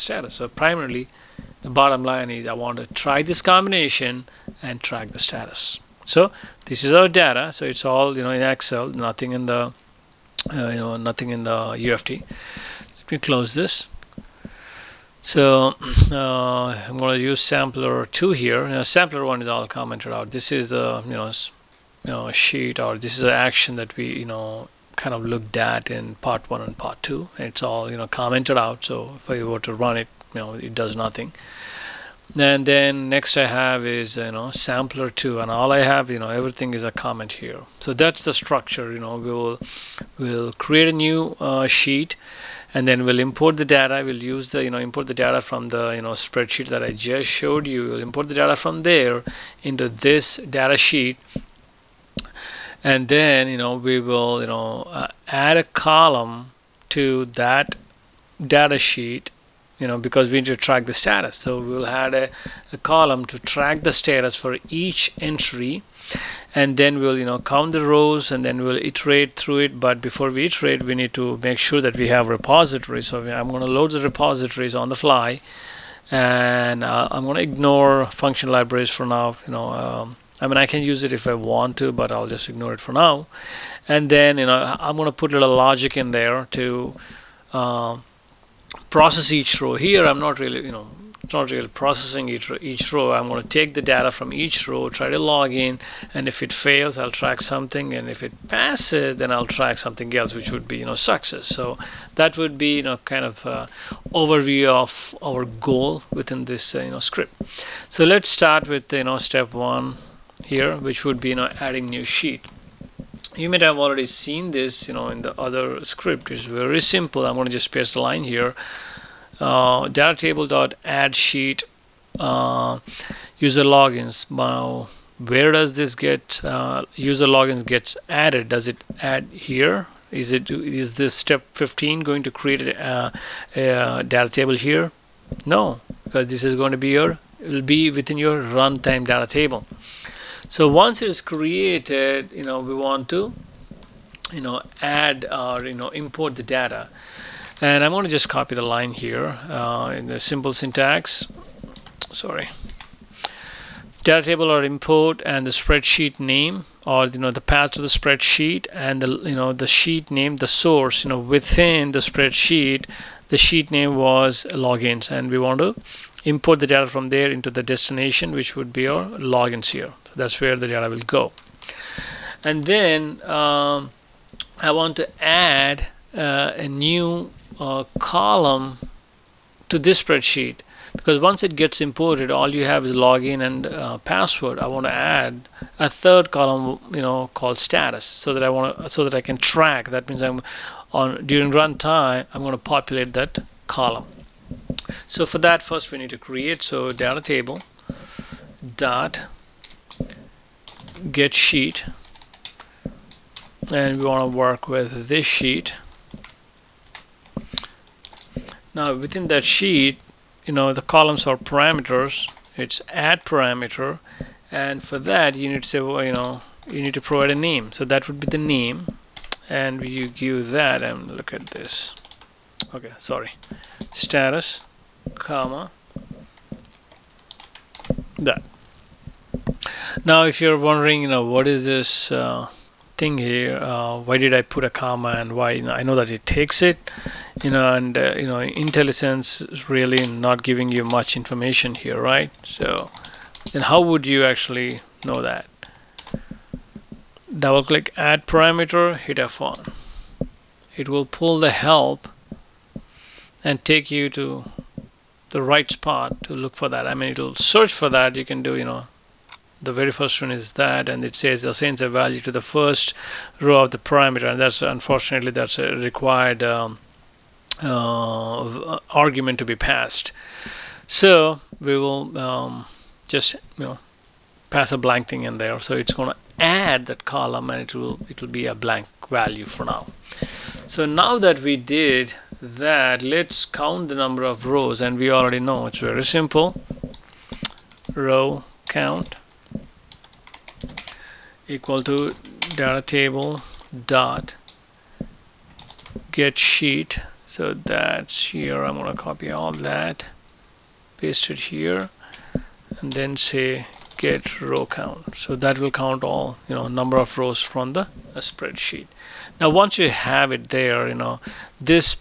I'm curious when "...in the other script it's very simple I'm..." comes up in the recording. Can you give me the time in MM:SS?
01:55.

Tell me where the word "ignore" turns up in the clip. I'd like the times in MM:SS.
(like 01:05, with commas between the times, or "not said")
01:17, 01:22.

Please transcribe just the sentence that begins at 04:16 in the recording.
I mean, it'll search for that.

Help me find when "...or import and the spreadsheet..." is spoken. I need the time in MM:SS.
02:34.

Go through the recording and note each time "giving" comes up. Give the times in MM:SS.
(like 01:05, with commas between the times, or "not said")
04:00.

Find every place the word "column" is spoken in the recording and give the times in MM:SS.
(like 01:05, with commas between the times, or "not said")
00:55, 01:02, 02:57, 03:06, 03:13, 03:30, 04:37.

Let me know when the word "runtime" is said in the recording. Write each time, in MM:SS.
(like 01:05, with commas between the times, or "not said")
02:18, 03:11.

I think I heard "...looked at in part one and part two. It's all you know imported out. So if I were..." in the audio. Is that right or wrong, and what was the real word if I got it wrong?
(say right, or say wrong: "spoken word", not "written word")
wrong: "commented", not "imported".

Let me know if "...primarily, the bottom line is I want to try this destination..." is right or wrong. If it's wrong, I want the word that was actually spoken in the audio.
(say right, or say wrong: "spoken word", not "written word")
wrong: "combination", not "destination".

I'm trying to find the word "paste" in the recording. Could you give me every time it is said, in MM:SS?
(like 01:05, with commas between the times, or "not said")
01:57, 05:00.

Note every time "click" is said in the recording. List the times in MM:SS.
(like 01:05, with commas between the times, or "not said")
04:07.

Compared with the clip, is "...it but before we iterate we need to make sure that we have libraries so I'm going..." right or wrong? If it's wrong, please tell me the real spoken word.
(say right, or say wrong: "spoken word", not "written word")
wrong: "repositories", not "libraries".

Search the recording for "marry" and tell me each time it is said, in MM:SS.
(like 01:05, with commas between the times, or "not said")
not said.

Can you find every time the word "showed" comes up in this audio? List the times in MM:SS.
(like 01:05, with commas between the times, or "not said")
00:47.